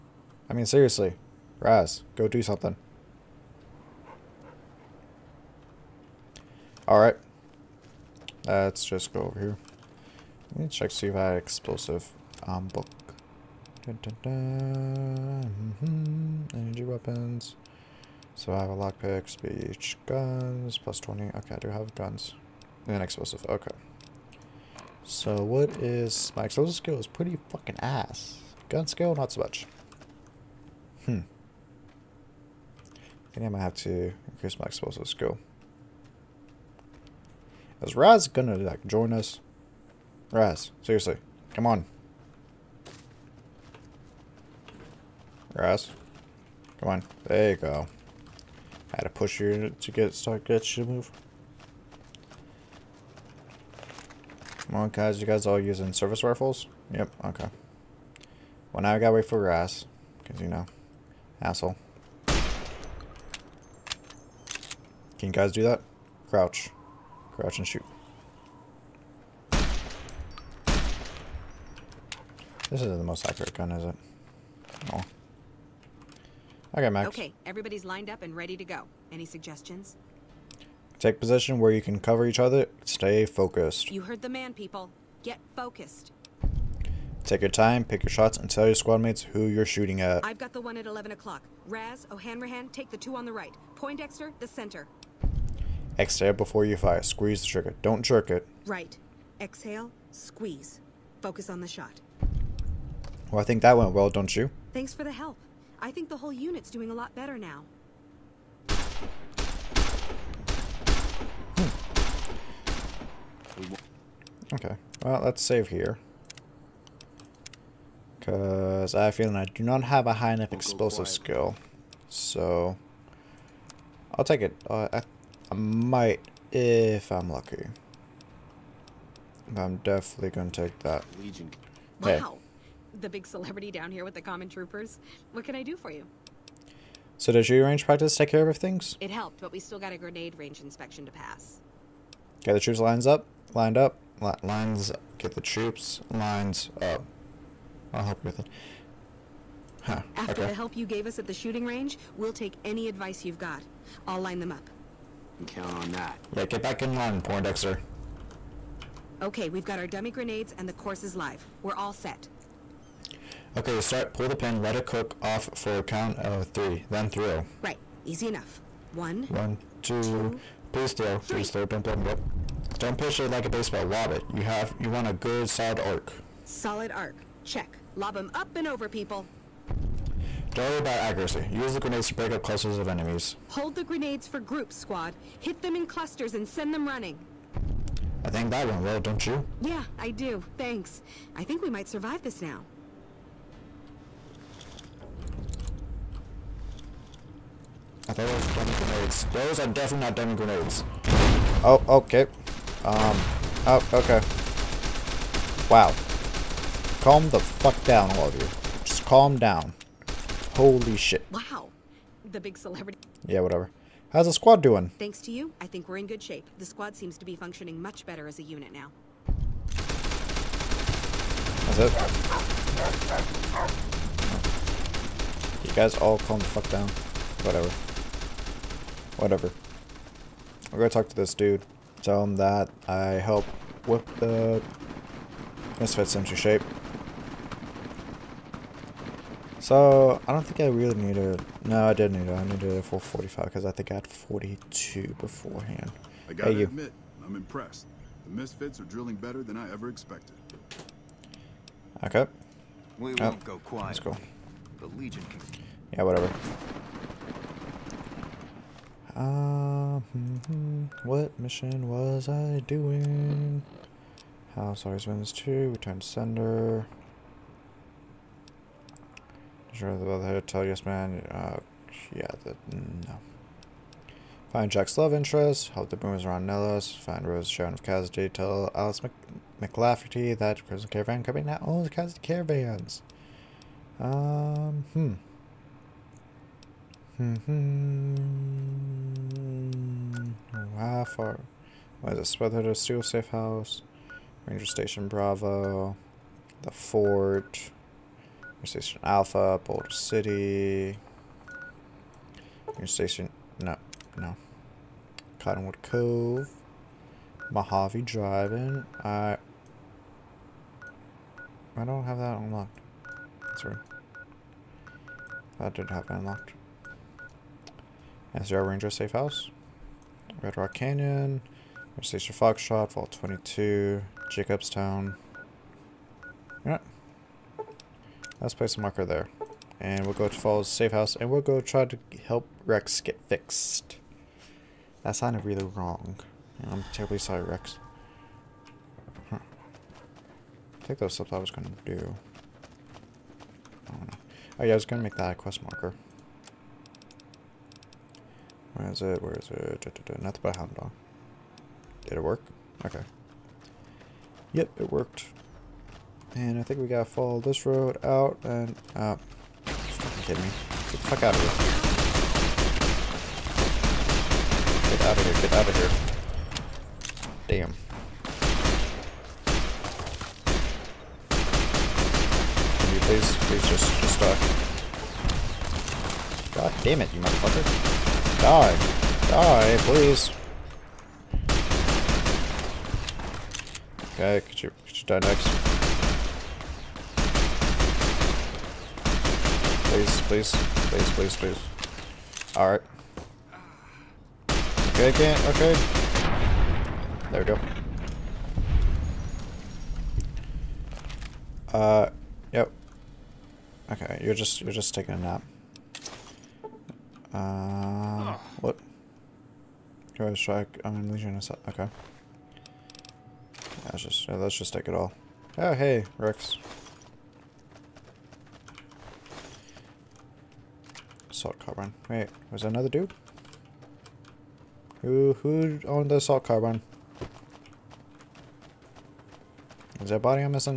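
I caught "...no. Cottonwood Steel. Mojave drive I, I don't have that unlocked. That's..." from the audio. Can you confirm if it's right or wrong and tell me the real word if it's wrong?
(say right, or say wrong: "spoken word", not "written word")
wrong: "Cove", not "Steel".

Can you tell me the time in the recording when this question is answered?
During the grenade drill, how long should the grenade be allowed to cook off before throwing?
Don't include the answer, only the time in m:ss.
2:45.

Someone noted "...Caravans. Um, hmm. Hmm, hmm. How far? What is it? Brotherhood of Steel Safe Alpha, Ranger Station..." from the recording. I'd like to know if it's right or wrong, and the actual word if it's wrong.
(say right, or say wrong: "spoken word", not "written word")
wrong: "House", not "Alpha".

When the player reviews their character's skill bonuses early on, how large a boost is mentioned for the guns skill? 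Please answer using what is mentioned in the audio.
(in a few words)
+20.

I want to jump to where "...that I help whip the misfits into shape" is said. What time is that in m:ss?
3:52.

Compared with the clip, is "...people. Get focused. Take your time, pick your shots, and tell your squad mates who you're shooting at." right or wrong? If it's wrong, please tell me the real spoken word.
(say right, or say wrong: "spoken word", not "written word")
right.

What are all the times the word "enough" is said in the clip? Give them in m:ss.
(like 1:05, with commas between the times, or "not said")
2:00, 2:48.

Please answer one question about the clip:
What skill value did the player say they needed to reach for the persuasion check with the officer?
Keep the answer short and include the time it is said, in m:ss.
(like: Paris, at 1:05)
45, at 4:02.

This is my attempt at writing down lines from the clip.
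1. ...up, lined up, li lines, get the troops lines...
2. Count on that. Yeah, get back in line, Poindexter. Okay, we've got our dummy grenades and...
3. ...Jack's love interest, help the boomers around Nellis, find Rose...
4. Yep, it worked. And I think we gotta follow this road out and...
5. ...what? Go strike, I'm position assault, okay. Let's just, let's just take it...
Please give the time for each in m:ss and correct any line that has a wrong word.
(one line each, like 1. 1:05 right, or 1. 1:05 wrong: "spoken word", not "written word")
1. 2:23 right
2. 2:35 right
3. 4:34 right
4. 5:54 right
5. 6:48 wrong: "legion", not "position".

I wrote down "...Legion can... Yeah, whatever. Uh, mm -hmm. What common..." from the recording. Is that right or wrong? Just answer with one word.
wrong.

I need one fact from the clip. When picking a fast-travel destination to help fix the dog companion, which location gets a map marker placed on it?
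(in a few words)
Jacobstown.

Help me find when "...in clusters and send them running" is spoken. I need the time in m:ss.
3:05.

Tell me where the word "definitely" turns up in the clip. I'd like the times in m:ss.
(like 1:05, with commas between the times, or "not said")
2:09, 3:19.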